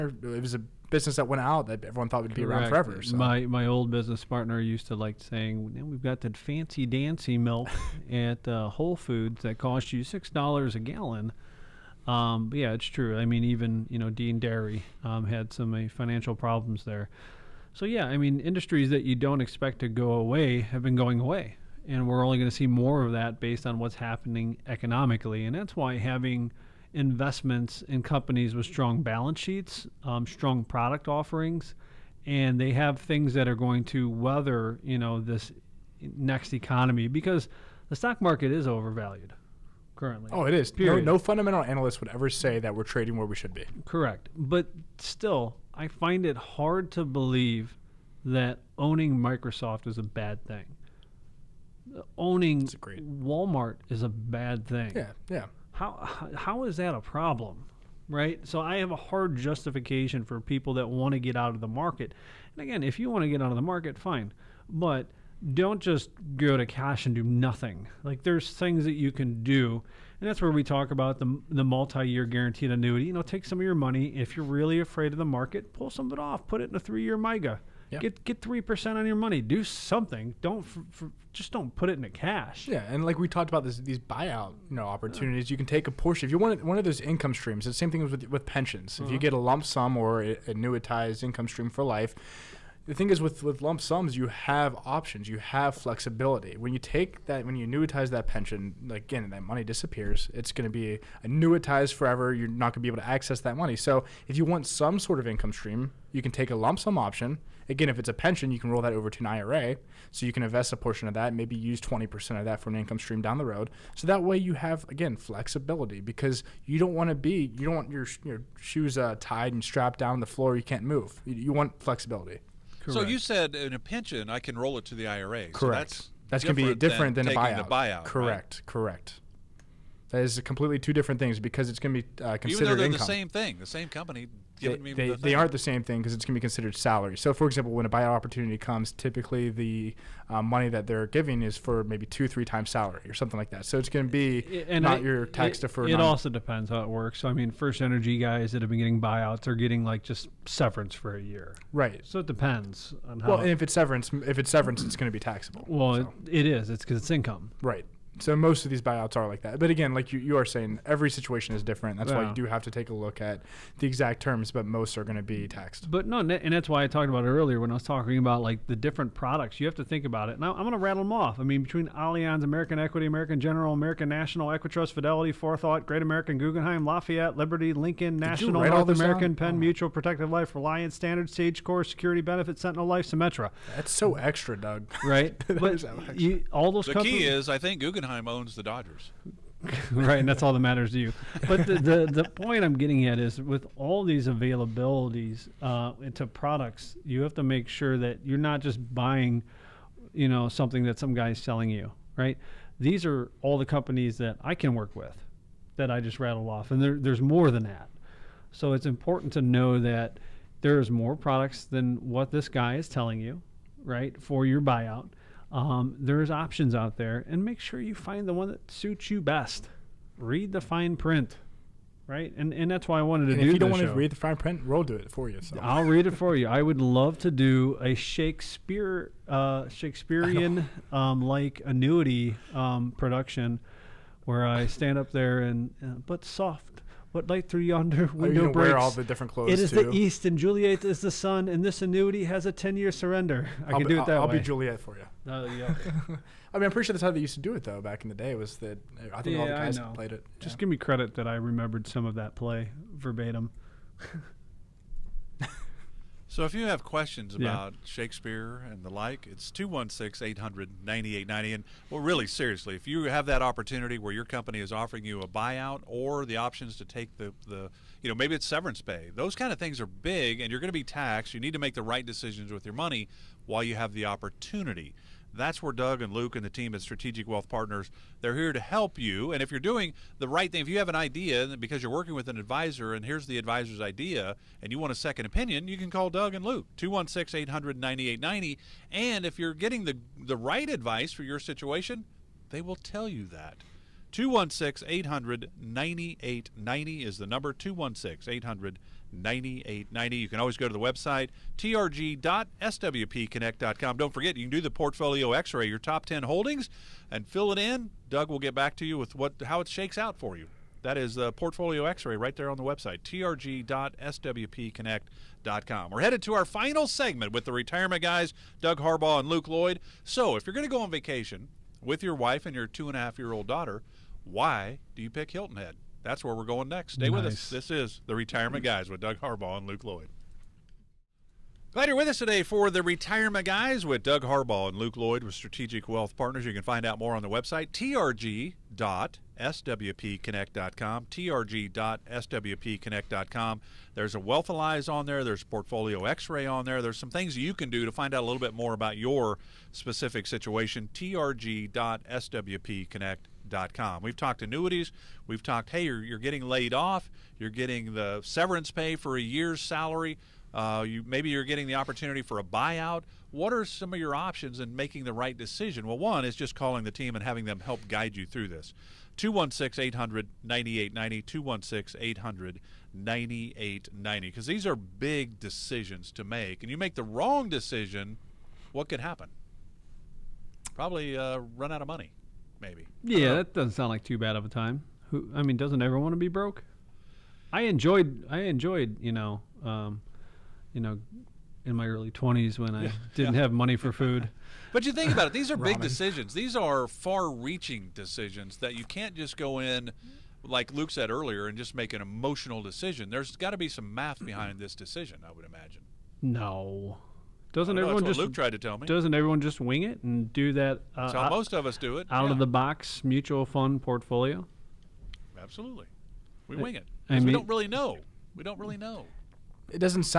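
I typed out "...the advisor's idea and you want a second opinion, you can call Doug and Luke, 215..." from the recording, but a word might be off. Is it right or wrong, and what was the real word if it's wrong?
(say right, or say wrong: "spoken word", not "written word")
wrong: "216", not "215".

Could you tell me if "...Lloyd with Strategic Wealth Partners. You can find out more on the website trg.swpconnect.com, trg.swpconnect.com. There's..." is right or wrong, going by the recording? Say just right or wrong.
right.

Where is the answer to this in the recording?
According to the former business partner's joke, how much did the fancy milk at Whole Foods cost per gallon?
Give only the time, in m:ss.
0:10.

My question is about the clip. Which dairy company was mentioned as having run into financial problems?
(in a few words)
Dean Dairy.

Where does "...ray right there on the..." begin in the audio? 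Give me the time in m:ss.
5:12.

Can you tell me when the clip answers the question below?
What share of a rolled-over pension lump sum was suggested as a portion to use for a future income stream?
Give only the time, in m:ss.
1:51.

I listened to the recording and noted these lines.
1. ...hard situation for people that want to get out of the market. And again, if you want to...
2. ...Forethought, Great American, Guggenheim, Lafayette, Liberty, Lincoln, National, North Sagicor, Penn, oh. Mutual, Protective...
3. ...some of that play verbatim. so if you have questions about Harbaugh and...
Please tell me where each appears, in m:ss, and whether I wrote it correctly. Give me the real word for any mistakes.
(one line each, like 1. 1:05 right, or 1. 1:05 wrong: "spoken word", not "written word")
1. 0:58 wrong: "justification", not "situation"
2. 2:55 wrong: "American", not "Sagicor"
3. 4:11 wrong: "Shakespeare", not "Harbaugh".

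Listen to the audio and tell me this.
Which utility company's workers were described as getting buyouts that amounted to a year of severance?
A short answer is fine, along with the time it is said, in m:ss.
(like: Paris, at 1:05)
First Energy, at 2:27.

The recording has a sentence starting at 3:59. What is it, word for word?
the east, and Juliet is the sun, and this annuity has a ten-year surrender.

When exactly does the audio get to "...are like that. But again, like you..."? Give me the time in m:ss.
2:39.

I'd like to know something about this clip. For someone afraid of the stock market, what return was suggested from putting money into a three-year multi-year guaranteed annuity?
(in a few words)
3%.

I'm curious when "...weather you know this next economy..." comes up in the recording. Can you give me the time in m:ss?
0:34.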